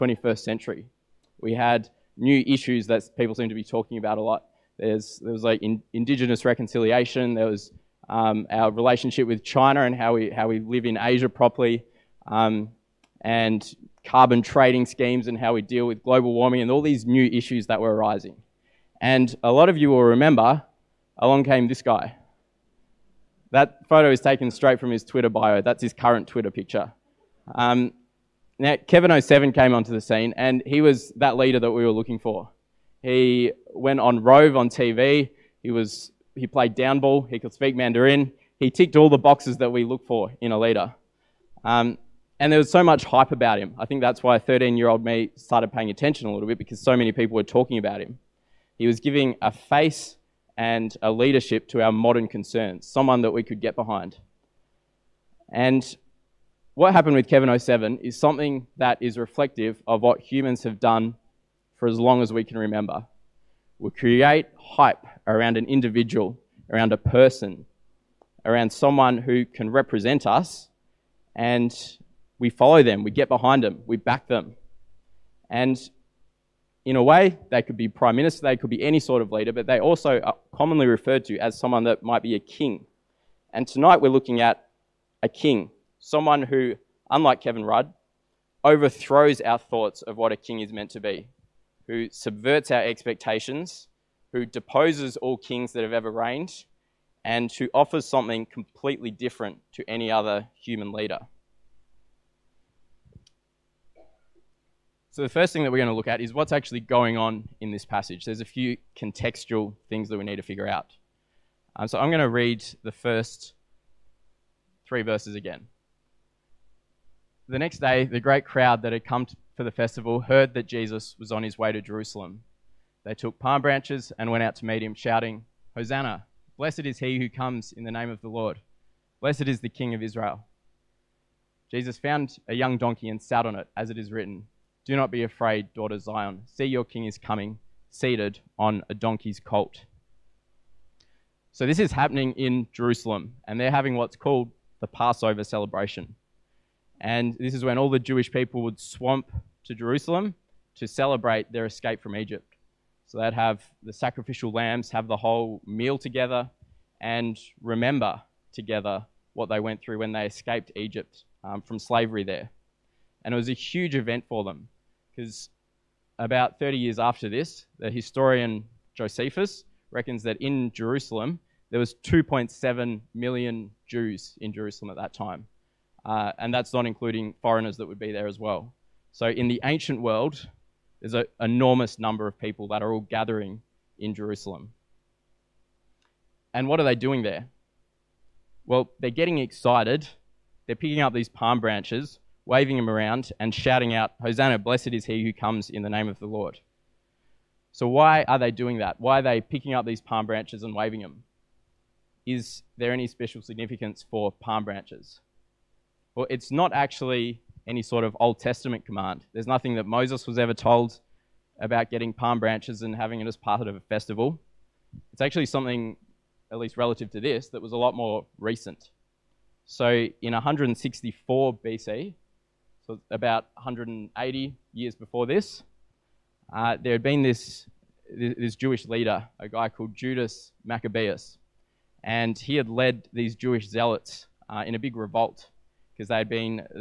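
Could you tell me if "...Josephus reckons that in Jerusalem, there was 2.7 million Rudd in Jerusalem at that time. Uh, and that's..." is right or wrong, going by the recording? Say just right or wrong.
wrong.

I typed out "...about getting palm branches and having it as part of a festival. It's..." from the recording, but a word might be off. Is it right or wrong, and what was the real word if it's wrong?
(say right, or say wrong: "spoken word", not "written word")
right.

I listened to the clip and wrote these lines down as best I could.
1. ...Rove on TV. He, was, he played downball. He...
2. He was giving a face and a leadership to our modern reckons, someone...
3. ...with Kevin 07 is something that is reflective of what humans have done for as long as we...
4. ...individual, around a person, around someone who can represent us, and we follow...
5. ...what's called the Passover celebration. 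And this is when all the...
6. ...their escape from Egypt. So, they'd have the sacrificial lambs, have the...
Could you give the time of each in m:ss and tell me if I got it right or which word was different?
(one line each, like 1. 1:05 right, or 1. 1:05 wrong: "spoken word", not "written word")
1. 0:34 right
2. 0:48 wrong: "concerns", not "reckons"
3. 0:57 right
4. 1:05 right
5. 2:23 right
6. 2:31 right.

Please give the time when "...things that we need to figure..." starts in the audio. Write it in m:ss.
1:49.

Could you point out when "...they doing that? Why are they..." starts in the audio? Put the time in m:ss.
3:18.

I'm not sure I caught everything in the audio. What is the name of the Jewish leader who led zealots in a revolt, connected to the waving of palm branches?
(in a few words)
Judas Maccabeus.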